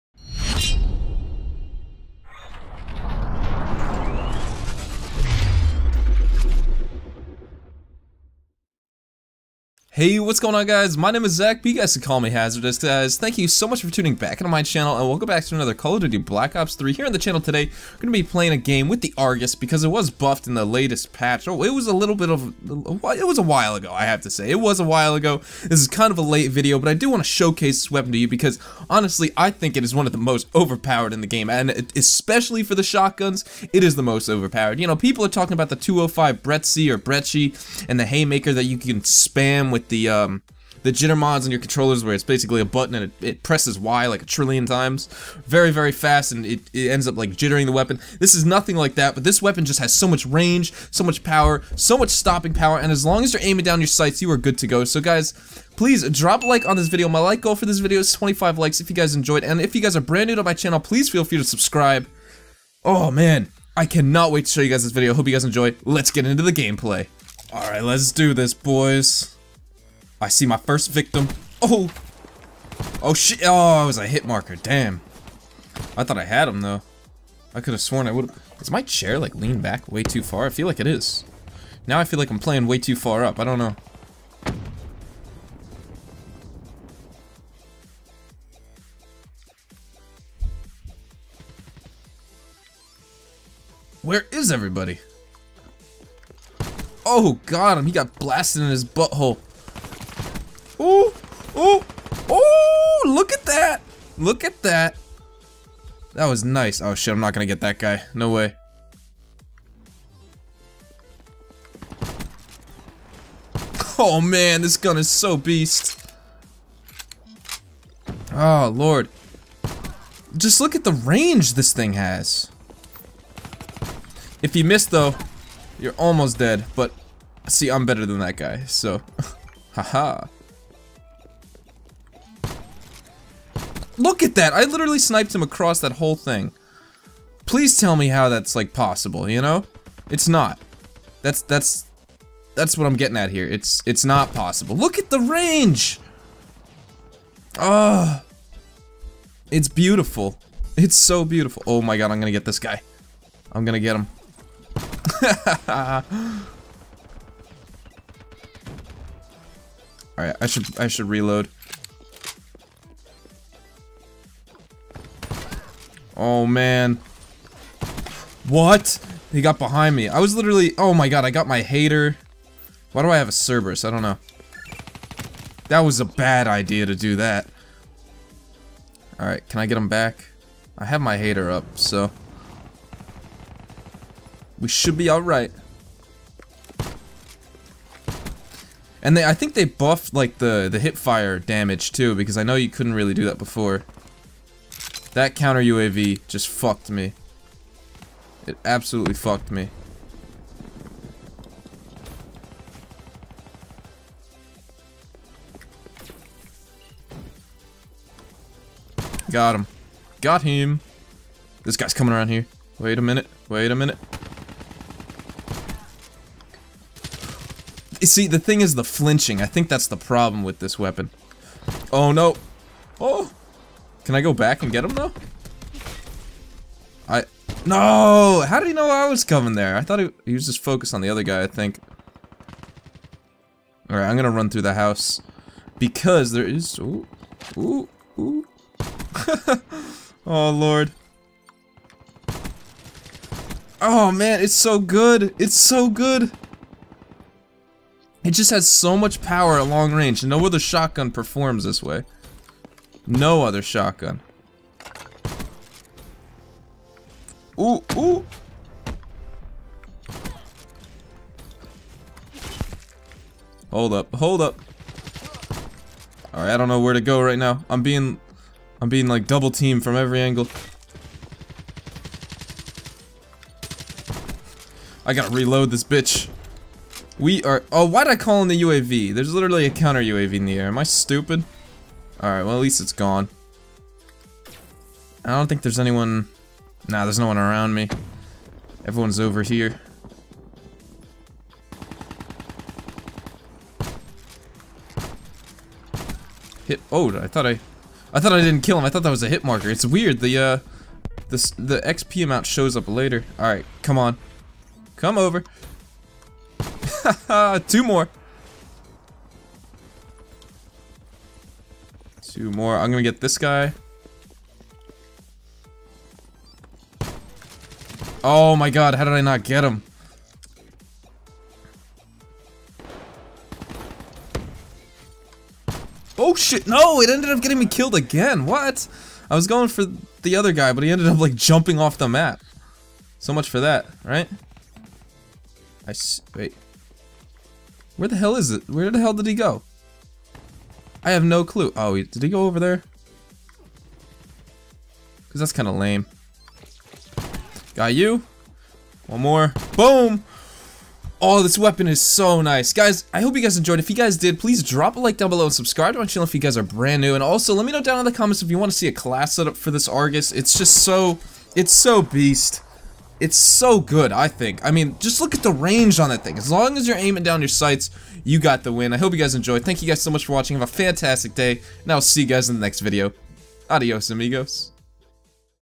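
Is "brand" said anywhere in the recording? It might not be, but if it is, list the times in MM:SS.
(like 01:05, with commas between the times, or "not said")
01:00, 05:56.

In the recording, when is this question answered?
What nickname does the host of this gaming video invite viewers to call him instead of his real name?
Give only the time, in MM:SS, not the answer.
00:12.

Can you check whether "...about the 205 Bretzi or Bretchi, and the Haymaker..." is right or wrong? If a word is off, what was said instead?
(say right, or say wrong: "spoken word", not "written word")
right.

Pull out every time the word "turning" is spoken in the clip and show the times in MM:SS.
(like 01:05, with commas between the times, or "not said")
not said.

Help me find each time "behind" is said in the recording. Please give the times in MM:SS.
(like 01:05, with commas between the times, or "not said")
02:49.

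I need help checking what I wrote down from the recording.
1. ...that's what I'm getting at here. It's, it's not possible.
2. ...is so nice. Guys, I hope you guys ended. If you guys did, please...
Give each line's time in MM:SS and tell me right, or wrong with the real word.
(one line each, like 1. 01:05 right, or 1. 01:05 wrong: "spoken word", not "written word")
1. 02:22 right
2. 05:51 wrong: "enjoyed", not "ended".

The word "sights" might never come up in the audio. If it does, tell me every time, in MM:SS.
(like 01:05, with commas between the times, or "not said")
00:53, 06:07.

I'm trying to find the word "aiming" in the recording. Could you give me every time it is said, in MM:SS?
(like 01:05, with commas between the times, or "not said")
00:53, 06:06.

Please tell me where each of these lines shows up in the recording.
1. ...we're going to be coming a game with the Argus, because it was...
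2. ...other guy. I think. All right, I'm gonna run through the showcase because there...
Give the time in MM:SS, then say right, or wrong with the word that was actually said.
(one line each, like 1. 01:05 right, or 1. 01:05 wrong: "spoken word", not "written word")
1. 00:17 wrong: "playing", not "coming"
2. 03:51 wrong: "house", not "showcase".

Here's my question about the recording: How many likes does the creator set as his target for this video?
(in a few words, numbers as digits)
25.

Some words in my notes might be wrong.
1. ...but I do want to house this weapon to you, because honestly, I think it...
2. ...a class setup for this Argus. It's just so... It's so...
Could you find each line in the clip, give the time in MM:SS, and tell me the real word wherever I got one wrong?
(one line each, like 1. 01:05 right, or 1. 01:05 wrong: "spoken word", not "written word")
1. 00:26 wrong: "showcase", not "house"
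2. 05:58 right.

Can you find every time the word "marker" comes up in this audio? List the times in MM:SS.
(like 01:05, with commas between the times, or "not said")
01:14, 04:59.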